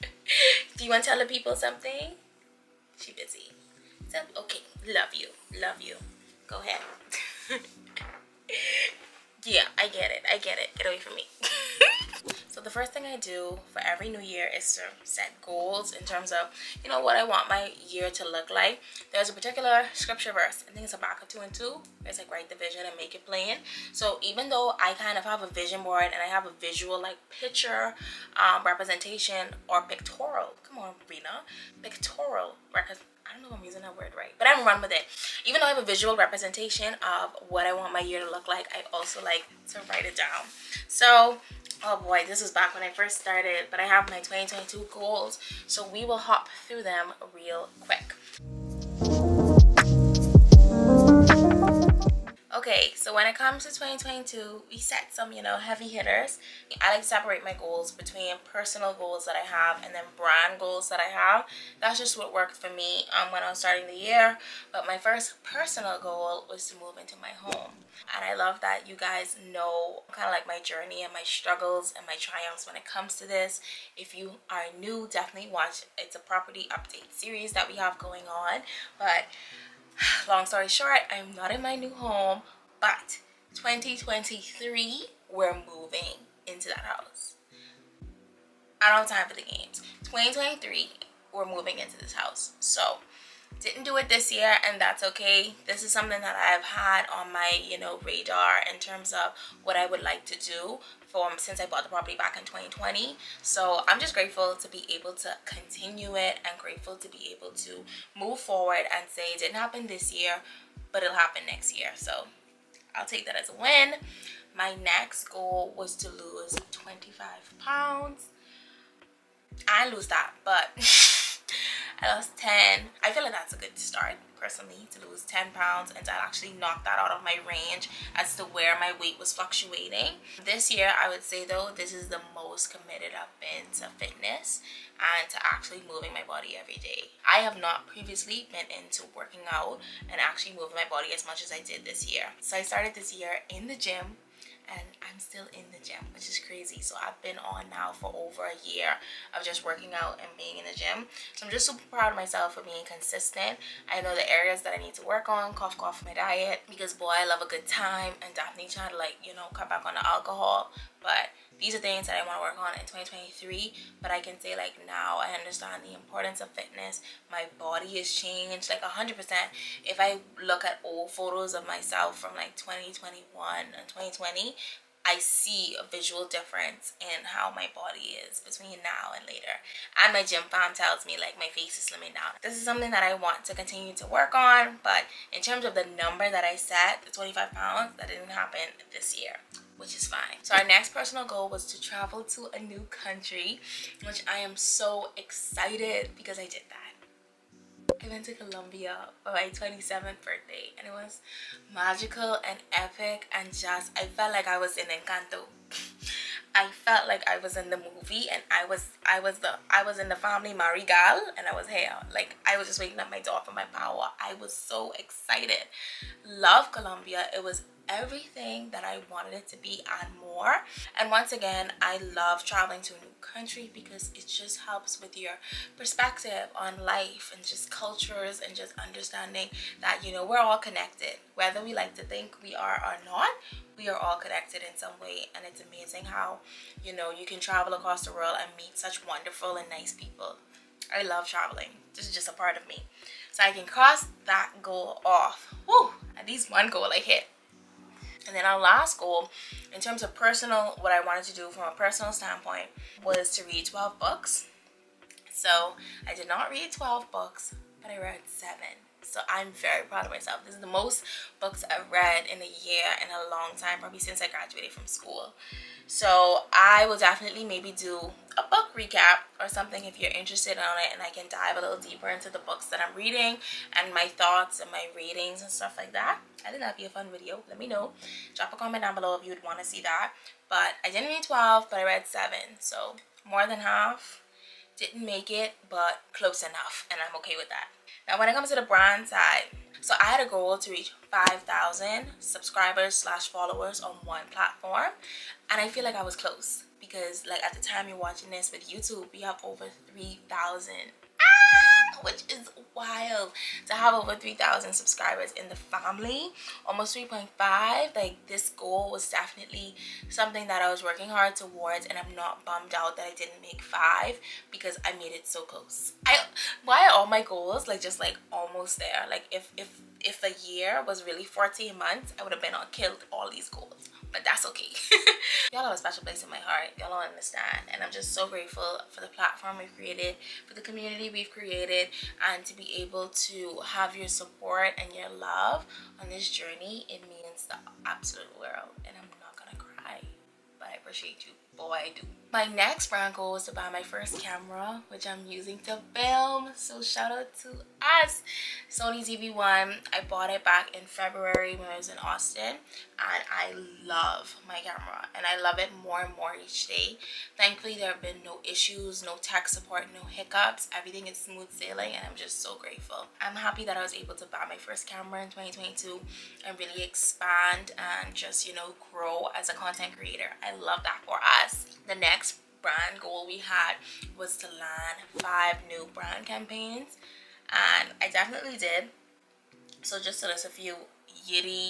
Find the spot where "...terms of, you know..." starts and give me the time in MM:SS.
00:16.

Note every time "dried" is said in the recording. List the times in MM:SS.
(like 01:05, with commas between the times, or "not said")
not said.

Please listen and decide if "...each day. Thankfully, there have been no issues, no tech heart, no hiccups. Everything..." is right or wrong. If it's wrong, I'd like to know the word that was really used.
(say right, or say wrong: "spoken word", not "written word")
wrong: "support", not "heart".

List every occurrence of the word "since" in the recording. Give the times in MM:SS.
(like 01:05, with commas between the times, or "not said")
01:41, 04:23.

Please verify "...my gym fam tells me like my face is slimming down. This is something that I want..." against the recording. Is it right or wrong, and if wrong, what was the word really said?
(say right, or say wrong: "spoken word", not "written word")
right.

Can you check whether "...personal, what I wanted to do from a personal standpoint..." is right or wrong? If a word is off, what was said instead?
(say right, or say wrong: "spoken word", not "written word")
right.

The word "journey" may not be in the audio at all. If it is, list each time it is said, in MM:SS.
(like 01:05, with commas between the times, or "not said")
01:10, 05:36.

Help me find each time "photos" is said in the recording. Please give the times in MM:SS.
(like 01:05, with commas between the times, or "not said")
02:51.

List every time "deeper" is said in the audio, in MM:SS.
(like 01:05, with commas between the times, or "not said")
04:31.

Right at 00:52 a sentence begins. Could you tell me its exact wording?
Okay, so when it comes to 2022, we set some, you know, heavy hitters.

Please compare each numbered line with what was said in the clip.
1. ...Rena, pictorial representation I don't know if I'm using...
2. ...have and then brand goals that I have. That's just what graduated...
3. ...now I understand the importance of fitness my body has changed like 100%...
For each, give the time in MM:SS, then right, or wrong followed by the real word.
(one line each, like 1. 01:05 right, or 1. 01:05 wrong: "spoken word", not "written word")
1. 00:31 right
2. 00:59 wrong: "worked", not "graduated"
3. 02:44 right.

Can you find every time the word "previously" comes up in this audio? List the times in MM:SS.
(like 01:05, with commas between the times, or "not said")
02:17.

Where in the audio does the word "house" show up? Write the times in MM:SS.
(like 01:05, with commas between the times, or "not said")
01:26, 01:32.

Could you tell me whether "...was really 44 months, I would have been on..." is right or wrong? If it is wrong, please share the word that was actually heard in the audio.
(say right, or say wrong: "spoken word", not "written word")
wrong: "14", not "44".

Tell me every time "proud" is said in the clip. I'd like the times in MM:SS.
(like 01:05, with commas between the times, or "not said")
02:31, 04:19.